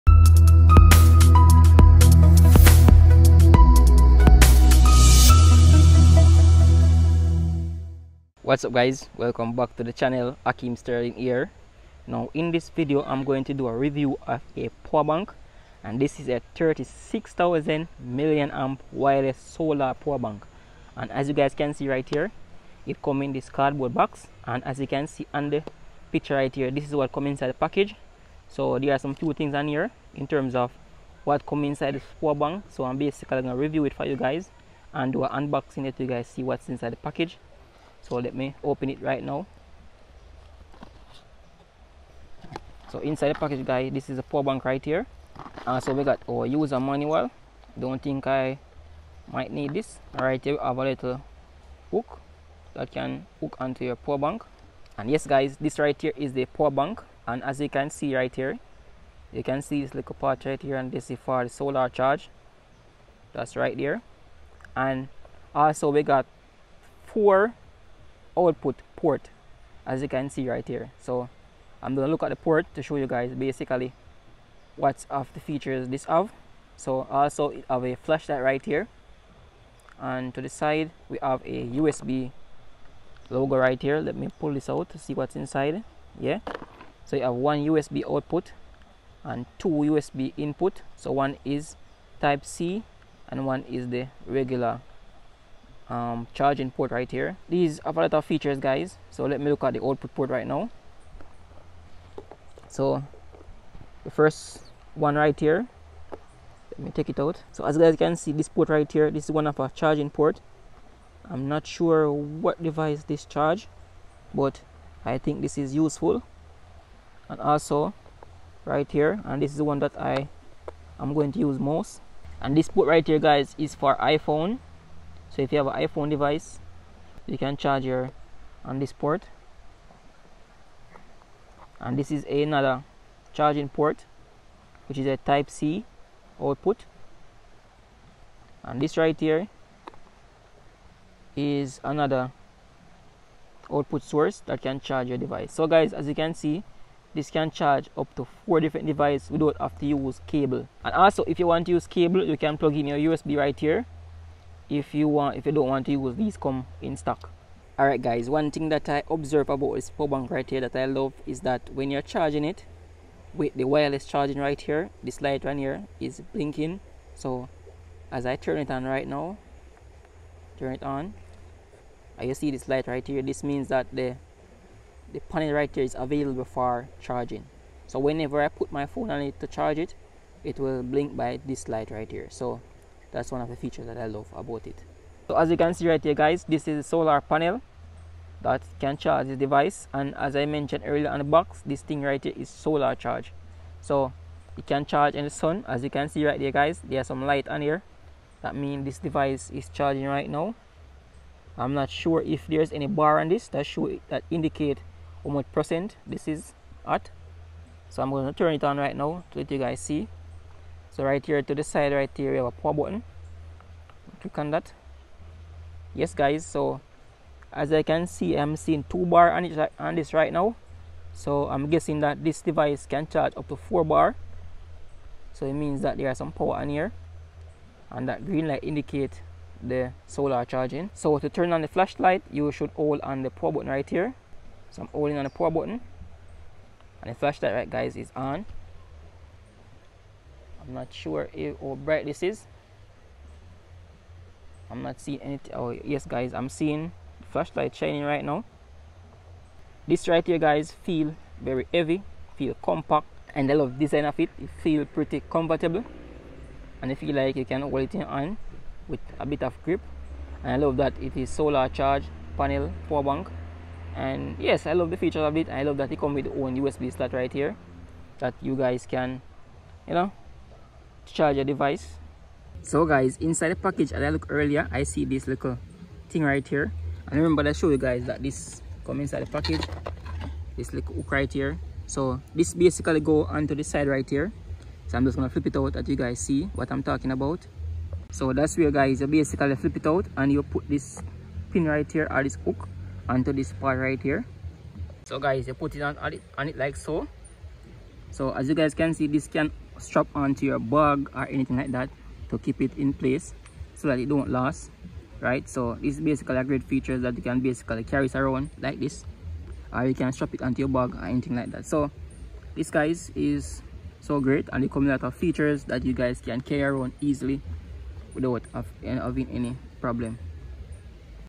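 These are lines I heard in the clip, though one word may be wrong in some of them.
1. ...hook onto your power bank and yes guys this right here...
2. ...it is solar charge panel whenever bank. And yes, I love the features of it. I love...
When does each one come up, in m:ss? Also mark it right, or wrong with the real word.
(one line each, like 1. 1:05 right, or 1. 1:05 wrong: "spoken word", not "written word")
1. 0:53 right
2. 4:21 wrong: "power", not "whenever".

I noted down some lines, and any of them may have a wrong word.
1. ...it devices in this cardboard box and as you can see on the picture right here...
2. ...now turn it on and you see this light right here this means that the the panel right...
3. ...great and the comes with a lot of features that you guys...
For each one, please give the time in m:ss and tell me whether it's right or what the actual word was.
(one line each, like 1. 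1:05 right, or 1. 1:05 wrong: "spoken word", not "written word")
1. 0:22 wrong: "comes", not "devices"
2. 2:49 right
3. 5:14 right.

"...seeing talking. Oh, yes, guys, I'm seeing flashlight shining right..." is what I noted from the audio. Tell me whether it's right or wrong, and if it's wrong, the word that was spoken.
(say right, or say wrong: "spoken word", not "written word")
wrong: "anything", not "talking".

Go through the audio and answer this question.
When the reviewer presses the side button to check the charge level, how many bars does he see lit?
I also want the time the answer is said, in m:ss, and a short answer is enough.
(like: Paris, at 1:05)
2, at 3:38.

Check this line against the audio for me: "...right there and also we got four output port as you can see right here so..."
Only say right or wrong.
right.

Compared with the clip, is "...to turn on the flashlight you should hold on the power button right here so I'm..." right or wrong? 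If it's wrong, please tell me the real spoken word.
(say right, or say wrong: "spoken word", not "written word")
right.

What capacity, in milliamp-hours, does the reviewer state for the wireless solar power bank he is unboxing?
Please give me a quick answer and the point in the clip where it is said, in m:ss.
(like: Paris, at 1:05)
36,000, at 0:16.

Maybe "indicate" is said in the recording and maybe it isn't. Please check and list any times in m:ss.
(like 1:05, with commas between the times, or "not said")
3:24, 3:48.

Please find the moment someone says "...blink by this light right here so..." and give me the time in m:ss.
3:00.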